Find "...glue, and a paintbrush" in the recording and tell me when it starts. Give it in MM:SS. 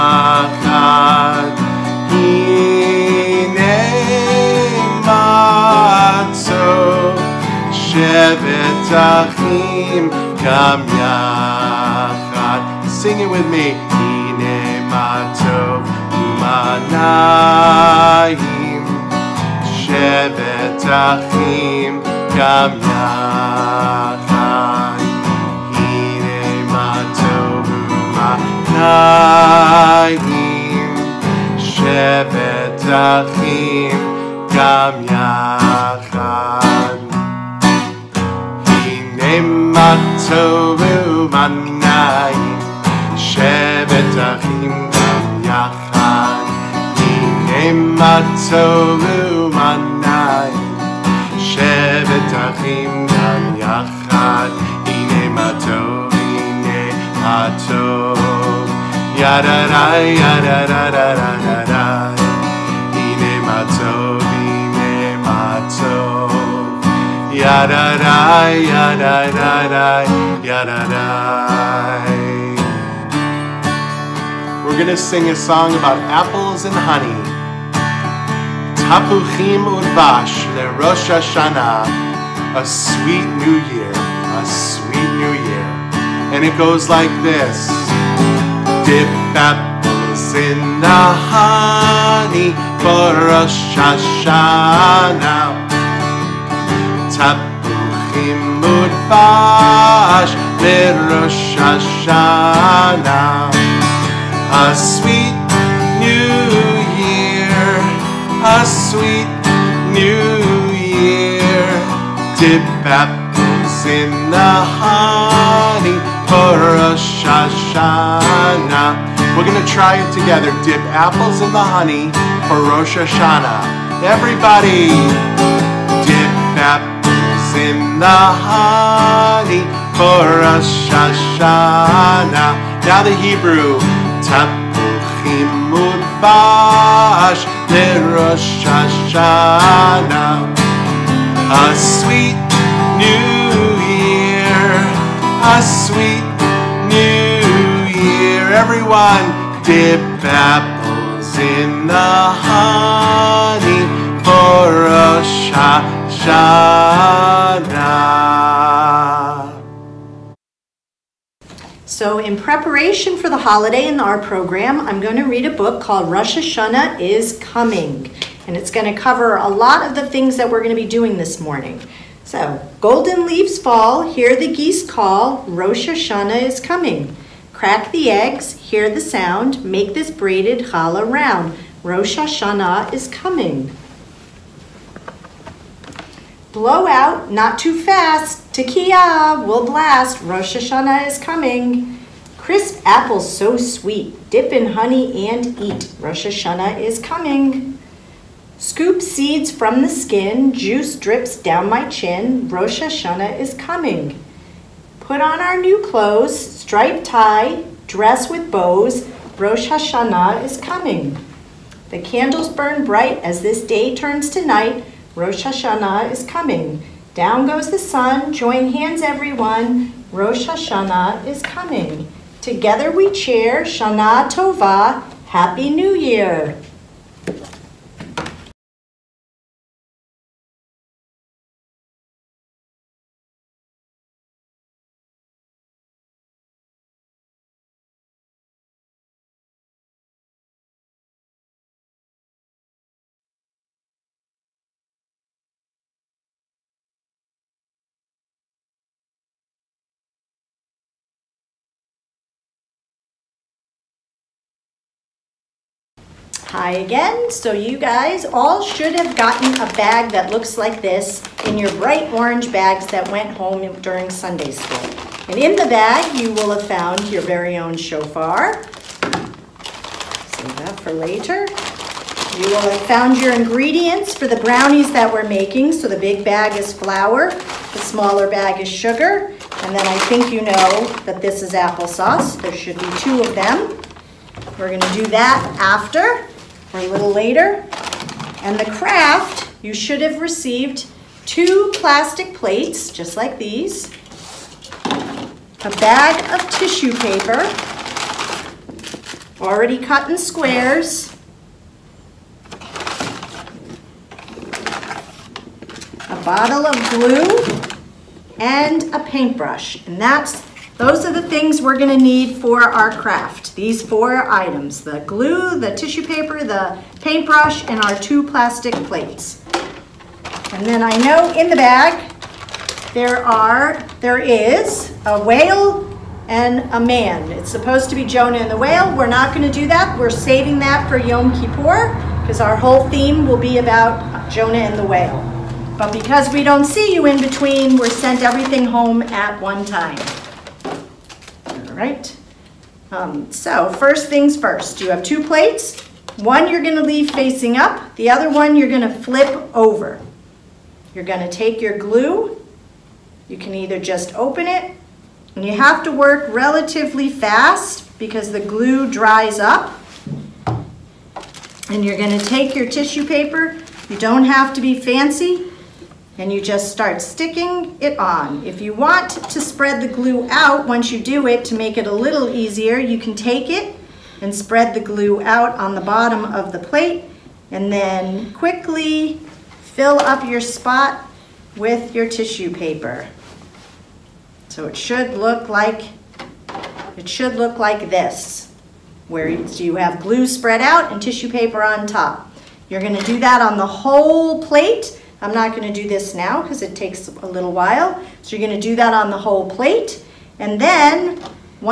05:06.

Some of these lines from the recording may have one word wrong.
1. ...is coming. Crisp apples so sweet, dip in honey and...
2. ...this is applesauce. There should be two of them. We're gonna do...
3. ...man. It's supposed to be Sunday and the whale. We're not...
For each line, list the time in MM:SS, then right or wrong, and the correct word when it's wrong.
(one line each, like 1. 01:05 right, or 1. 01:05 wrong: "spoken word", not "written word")
1. 03:11 right
2. 04:41 right
3. 05:26 wrong: "Jonah", not "Sunday".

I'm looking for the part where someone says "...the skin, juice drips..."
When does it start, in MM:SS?
03:19.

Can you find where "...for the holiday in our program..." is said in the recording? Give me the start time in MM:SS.
02:43.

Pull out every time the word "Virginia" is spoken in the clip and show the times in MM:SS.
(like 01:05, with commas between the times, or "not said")
not said.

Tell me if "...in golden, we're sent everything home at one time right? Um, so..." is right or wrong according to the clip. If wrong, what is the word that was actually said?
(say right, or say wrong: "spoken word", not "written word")
wrong: "between", not "golden".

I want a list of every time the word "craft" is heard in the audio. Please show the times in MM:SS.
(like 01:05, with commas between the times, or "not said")
04:48, 05:12.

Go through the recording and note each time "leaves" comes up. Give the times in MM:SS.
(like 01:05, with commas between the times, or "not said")
02:53, 05:46.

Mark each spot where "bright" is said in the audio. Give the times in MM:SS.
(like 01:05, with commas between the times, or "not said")
03:32, 04:21.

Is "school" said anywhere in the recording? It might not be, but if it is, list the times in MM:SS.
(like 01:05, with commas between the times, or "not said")
04:24.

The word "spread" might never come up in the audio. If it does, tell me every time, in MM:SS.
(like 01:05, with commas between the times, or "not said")
06:09, 06:14, 06:30.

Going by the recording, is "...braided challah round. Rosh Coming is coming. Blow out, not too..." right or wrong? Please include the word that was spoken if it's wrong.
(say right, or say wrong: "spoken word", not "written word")
wrong: "Hashanah", not "Coming".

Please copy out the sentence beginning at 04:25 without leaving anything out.
And in the bag, you will have found your very own shofar.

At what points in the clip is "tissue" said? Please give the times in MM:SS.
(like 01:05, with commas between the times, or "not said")
04:56, 05:15, 06:02, 06:22, 06:31.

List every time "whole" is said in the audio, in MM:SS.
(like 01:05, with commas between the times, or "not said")
05:32, 06:33, 06:39.